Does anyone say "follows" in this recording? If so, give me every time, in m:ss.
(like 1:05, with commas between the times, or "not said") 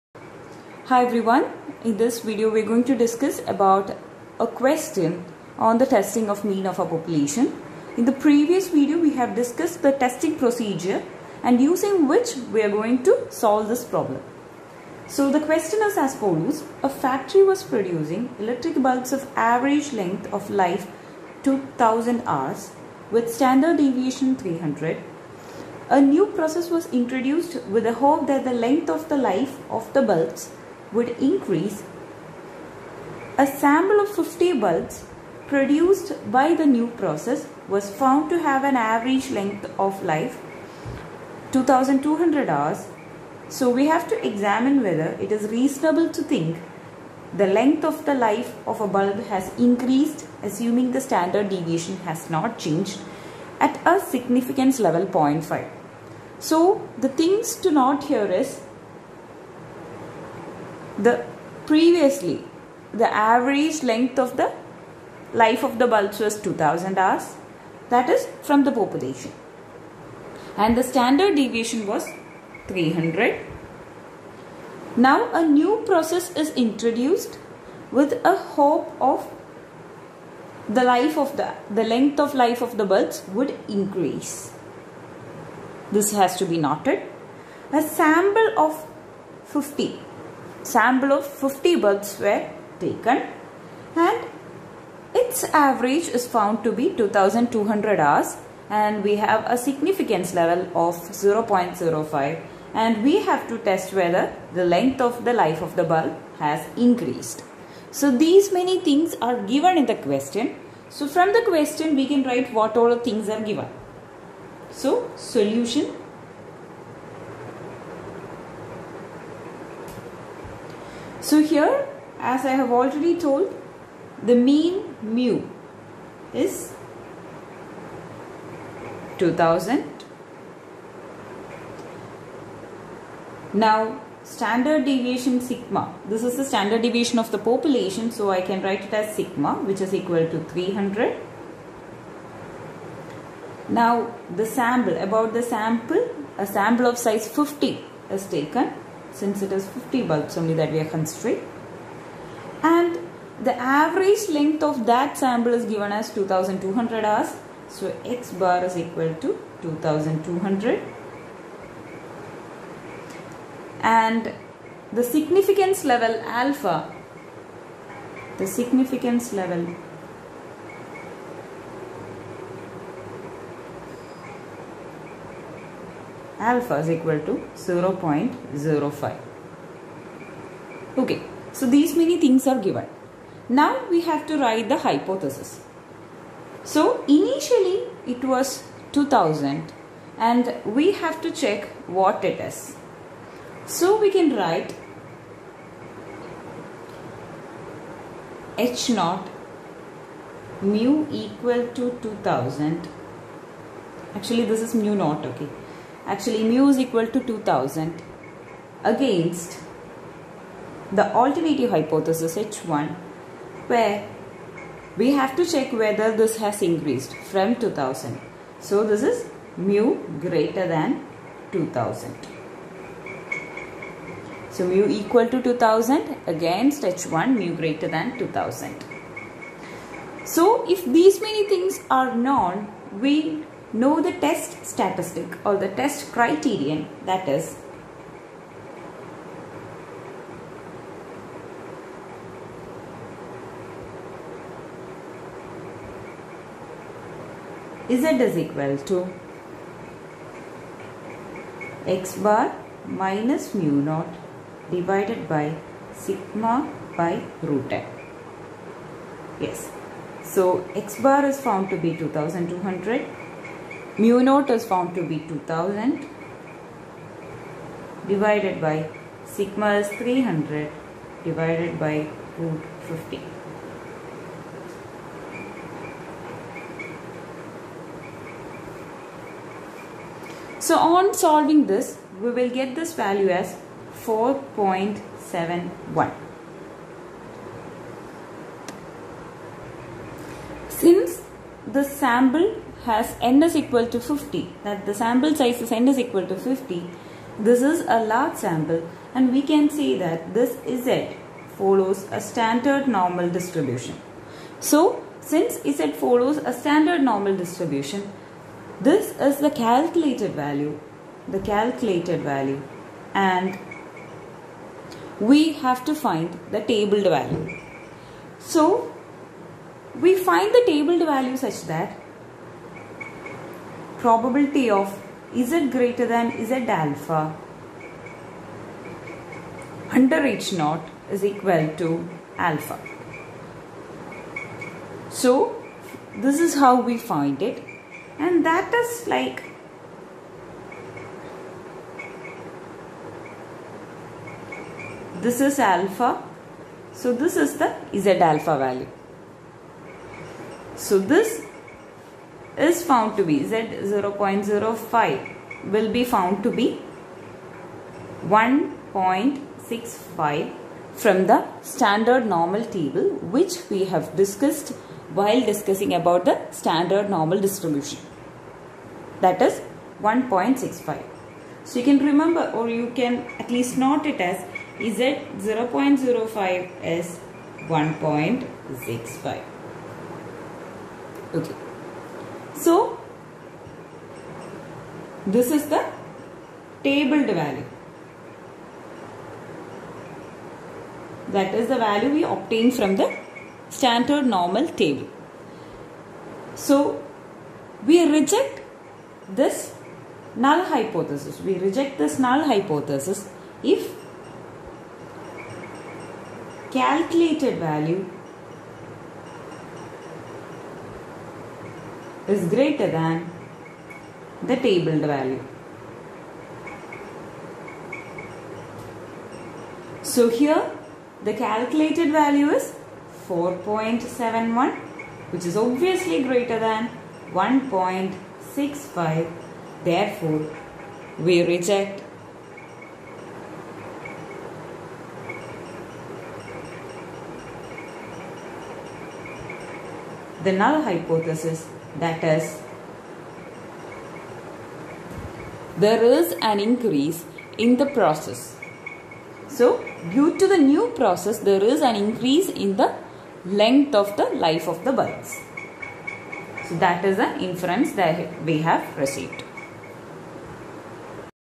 0:16, 5:01, 5:06.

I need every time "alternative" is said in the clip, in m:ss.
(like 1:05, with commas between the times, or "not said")
3:31.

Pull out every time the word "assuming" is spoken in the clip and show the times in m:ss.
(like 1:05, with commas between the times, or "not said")
0:50.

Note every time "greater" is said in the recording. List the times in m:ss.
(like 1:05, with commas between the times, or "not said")
3:40, 3:47, 5:25, 6:52, 7:06.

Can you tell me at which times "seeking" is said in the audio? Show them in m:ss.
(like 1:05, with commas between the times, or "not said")
not said.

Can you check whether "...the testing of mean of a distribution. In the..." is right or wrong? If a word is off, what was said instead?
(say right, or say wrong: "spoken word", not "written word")
wrong: "population", not "distribution".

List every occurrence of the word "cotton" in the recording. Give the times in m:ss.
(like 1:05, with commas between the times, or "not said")
not said.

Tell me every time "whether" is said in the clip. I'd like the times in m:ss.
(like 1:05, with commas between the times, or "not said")
0:44, 1:43, 3:35.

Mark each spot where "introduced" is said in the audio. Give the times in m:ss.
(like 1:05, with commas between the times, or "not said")
0:26, 1:16.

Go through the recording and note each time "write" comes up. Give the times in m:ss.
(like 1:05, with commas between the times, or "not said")
1:52, 2:18, 3:04, 3:14.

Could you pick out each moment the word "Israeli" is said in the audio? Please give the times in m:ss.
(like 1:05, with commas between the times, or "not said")
not said.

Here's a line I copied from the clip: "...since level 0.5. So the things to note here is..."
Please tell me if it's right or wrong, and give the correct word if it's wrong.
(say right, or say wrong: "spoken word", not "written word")
wrong: "significance", not "since".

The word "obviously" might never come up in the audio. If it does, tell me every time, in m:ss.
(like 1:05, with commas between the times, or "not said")
7:05.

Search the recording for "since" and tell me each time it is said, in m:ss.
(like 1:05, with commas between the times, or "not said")
2:29, 4:50, 5:05.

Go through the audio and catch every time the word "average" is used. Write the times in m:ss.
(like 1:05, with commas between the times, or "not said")
0:19, 0:38, 1:03, 1:35, 2:33.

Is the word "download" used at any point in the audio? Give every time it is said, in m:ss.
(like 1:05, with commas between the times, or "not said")
not said.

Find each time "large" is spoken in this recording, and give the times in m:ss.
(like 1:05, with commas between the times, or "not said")
4:58.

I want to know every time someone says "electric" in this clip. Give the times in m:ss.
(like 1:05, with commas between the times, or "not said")
0:18.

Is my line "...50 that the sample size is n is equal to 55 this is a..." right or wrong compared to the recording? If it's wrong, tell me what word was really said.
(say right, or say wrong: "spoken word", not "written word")
wrong: "50", not "55".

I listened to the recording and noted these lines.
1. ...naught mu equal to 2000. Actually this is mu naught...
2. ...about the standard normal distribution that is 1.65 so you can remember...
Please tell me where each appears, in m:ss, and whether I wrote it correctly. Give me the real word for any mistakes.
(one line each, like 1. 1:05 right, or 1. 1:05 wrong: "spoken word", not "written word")
1. 3:18 right
2. 6:05 right.